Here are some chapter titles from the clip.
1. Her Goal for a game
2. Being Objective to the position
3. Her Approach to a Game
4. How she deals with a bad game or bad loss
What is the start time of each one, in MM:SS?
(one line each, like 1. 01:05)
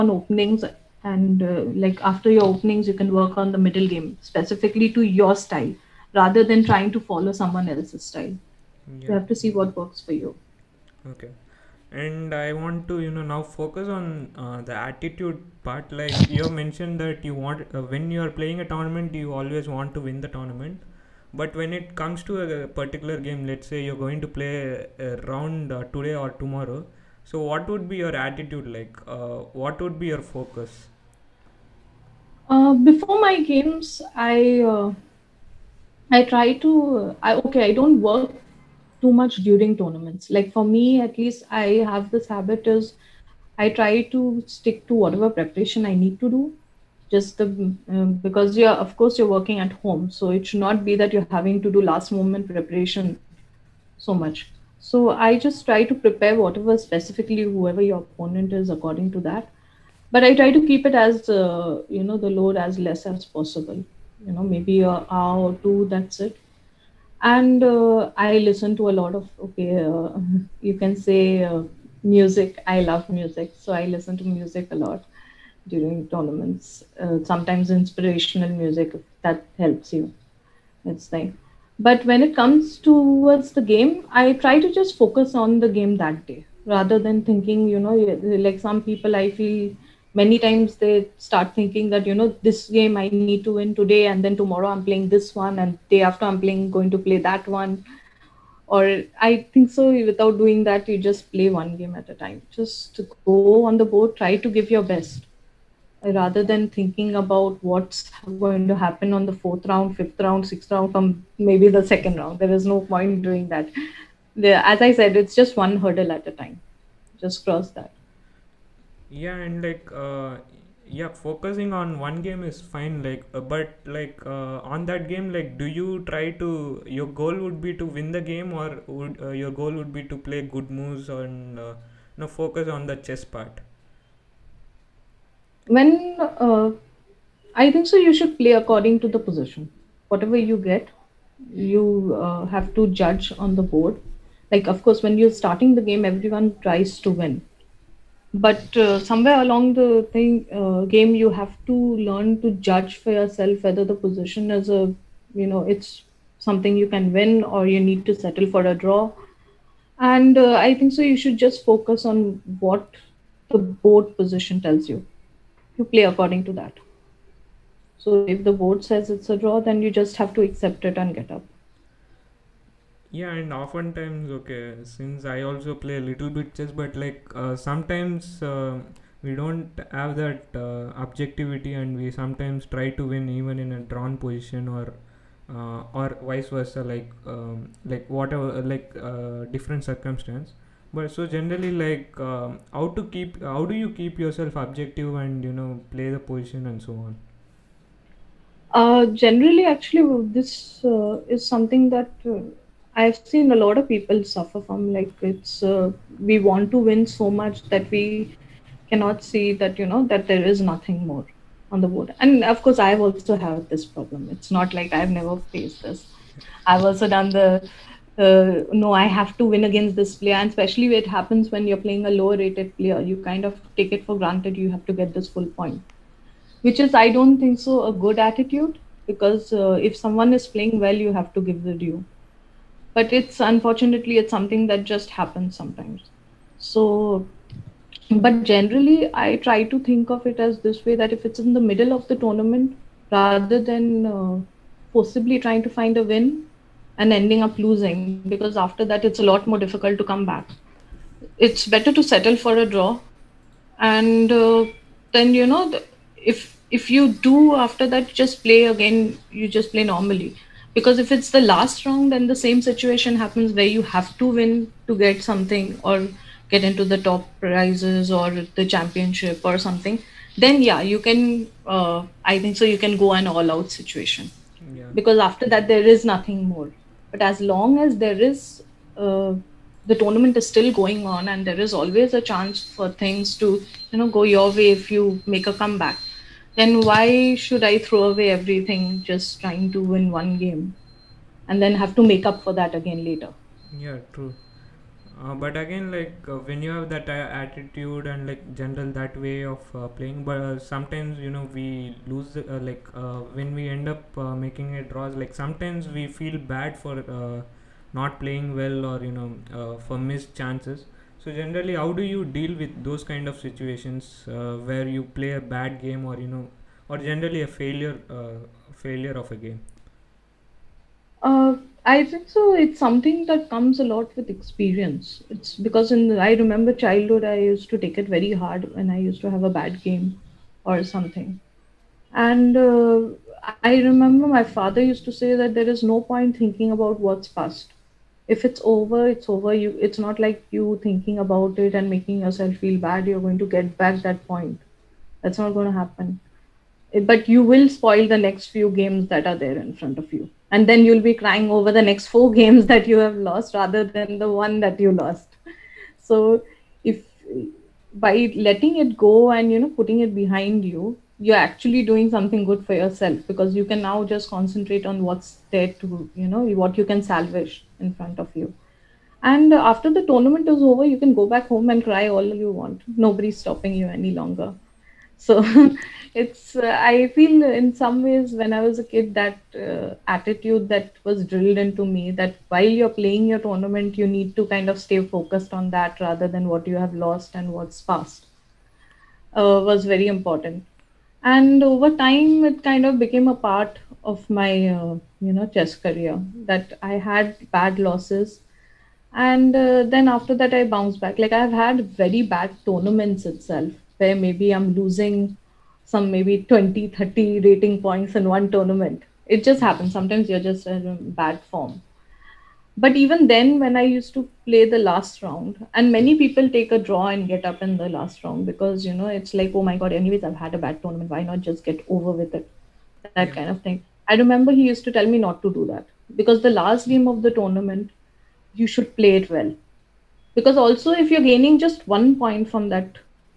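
1. 01:59
2. 03:26
3. 00:16
4. 04:56.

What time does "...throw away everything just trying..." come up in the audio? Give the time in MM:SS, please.
04:47.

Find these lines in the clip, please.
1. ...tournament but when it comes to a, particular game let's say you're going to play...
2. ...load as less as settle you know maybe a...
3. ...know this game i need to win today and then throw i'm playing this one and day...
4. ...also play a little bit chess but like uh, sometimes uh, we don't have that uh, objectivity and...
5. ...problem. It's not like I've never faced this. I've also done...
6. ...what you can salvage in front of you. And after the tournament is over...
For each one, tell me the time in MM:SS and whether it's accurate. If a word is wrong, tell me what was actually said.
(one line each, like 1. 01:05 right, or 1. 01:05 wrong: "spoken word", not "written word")
1. 00:20 right
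2. 01:02 wrong: "possible", not "settle"
3. 01:32 wrong: "tomorrow", not "throw"
4. 02:55 right
5. 03:33 right
6. 06:06 right.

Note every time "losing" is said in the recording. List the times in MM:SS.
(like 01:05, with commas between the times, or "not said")
04:07, 06:44.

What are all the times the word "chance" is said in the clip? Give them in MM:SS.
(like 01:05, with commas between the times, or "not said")
04:42, 05:10.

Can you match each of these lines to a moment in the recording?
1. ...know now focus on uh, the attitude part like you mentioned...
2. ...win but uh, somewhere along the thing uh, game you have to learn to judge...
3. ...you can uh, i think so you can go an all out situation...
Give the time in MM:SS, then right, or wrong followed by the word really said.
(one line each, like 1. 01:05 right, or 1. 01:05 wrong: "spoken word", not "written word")
1. 00:13 right
2. 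02:27 right
3. 04:30 right.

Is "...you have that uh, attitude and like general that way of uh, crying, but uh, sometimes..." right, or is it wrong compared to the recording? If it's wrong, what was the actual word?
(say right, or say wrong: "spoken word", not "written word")
wrong: "playing", not "crying".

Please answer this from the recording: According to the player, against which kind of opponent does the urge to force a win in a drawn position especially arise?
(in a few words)
lower-rated player.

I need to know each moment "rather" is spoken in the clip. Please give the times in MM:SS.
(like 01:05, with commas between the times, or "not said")
00:06, 01:26, 01:46, 04:03, 05:53, 06:25.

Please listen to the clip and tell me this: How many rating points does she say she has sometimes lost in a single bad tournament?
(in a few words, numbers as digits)
20-30.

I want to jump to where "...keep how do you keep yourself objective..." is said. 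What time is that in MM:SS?
03:13.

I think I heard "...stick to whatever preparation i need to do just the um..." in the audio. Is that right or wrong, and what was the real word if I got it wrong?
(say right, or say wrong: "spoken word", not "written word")
right.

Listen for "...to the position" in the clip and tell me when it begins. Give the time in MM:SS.
02:19.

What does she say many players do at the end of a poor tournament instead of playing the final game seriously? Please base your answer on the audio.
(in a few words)
take a draw.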